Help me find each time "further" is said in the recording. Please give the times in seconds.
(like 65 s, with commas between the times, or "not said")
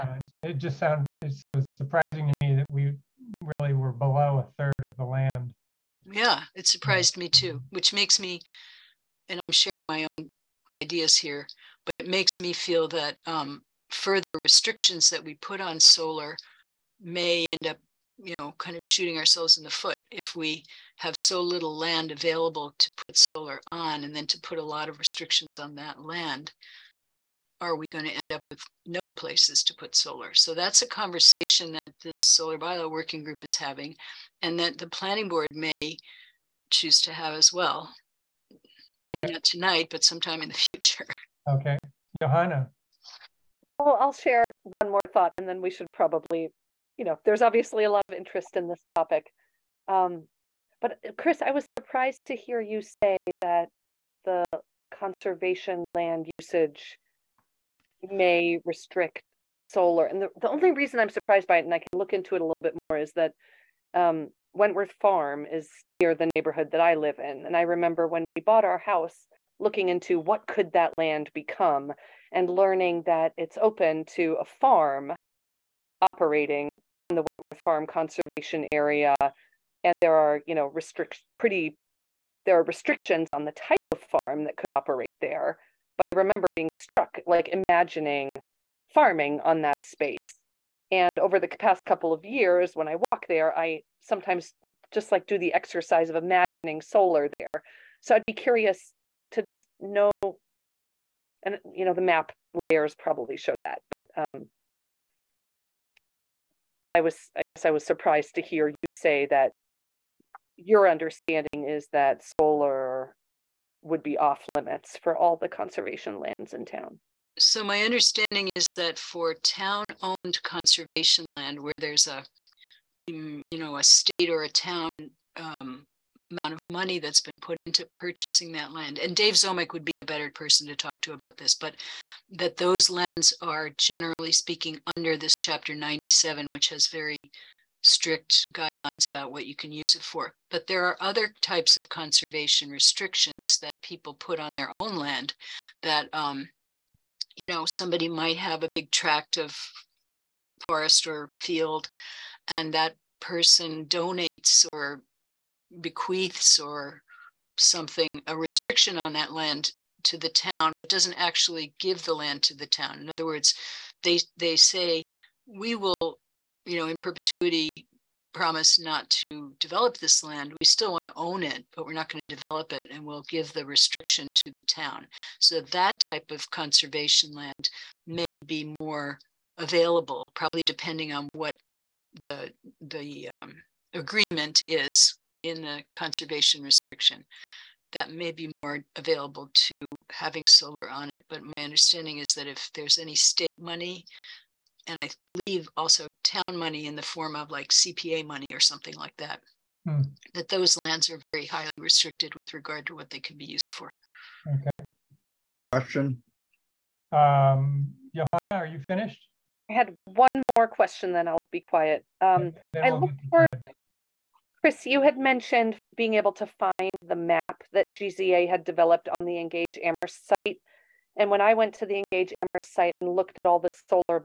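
13 s.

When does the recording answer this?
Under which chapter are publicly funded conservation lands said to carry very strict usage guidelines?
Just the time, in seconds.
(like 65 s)
135 s.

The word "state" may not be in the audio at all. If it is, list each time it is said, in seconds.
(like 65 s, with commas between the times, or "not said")
123 s, 193 s.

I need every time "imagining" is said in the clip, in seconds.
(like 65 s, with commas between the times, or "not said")
87 s, 96 s.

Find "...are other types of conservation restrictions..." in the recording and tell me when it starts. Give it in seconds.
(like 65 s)
140 s.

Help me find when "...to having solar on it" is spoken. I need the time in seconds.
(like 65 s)
189 s.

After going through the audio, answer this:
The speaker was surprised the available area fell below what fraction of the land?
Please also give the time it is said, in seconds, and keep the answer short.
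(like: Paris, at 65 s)
a third, at 4 s.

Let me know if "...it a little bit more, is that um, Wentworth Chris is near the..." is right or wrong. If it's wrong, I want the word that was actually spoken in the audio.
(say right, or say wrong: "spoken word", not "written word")
wrong: "Farm", not "Chris".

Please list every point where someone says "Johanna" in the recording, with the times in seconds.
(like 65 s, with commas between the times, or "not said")
42 s, 208 s.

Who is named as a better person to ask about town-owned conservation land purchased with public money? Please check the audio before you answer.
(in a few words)
Dave Ziomek.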